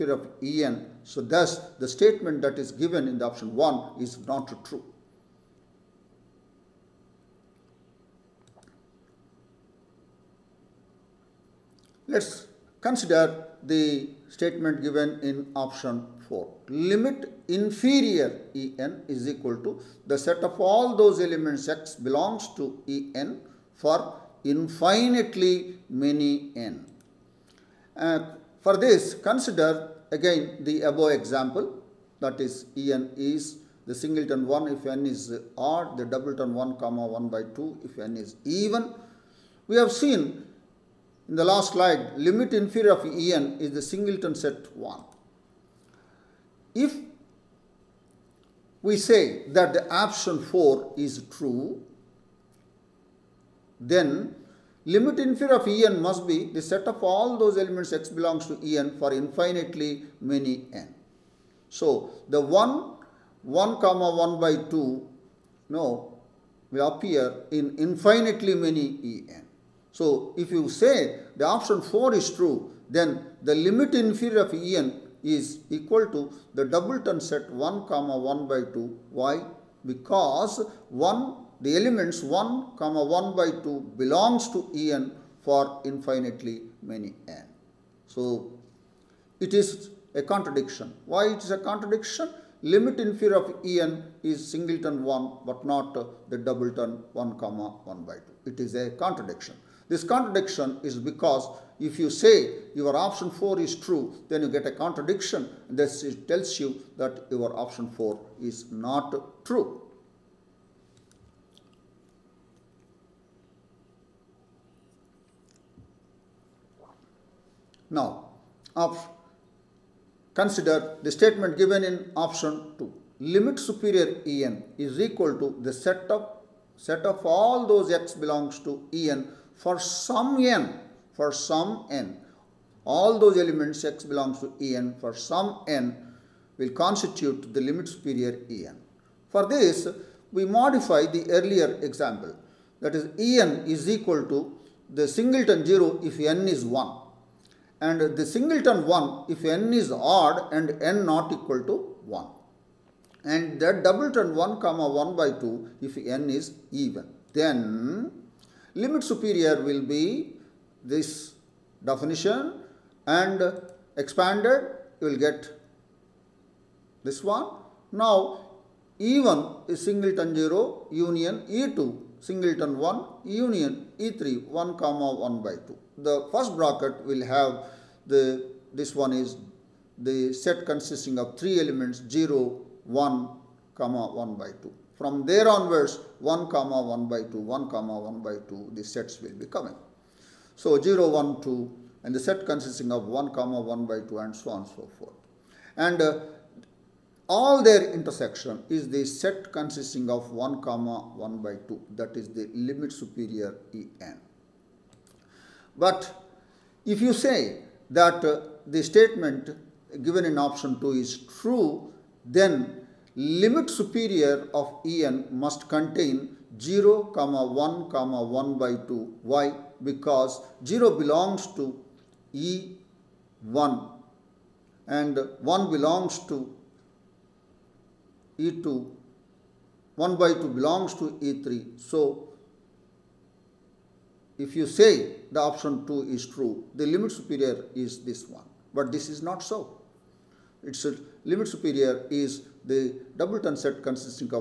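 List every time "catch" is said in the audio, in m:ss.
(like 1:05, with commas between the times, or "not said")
not said.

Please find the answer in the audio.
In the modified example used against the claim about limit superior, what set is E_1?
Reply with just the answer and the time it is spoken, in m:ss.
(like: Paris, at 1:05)
{0}, at 2:24.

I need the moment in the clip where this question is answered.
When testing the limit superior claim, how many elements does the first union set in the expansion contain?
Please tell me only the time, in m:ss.
3:01.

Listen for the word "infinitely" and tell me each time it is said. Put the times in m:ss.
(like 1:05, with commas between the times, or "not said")
0:24, 0:59, 1:07, 1:25.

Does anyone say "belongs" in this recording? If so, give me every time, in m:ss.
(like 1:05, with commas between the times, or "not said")
0:22, 0:58, 1:24, 2:08, 2:14, 3:40, 3:45, 3:50.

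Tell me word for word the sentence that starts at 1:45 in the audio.
This tells you that your option 4 is not true.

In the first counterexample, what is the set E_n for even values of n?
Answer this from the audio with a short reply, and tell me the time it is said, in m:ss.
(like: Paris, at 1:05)
{1, 1/2}, at 0:36.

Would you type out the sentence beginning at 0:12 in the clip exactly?
Let's consider the statement given in option 4.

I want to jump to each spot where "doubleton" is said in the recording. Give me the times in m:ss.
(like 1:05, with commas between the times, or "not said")
0:36, 1:16, 1:36, 2:33, 4:03.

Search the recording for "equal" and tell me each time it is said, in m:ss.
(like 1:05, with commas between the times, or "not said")
0:19, 1:15, 2:04, 2:23, 2:31.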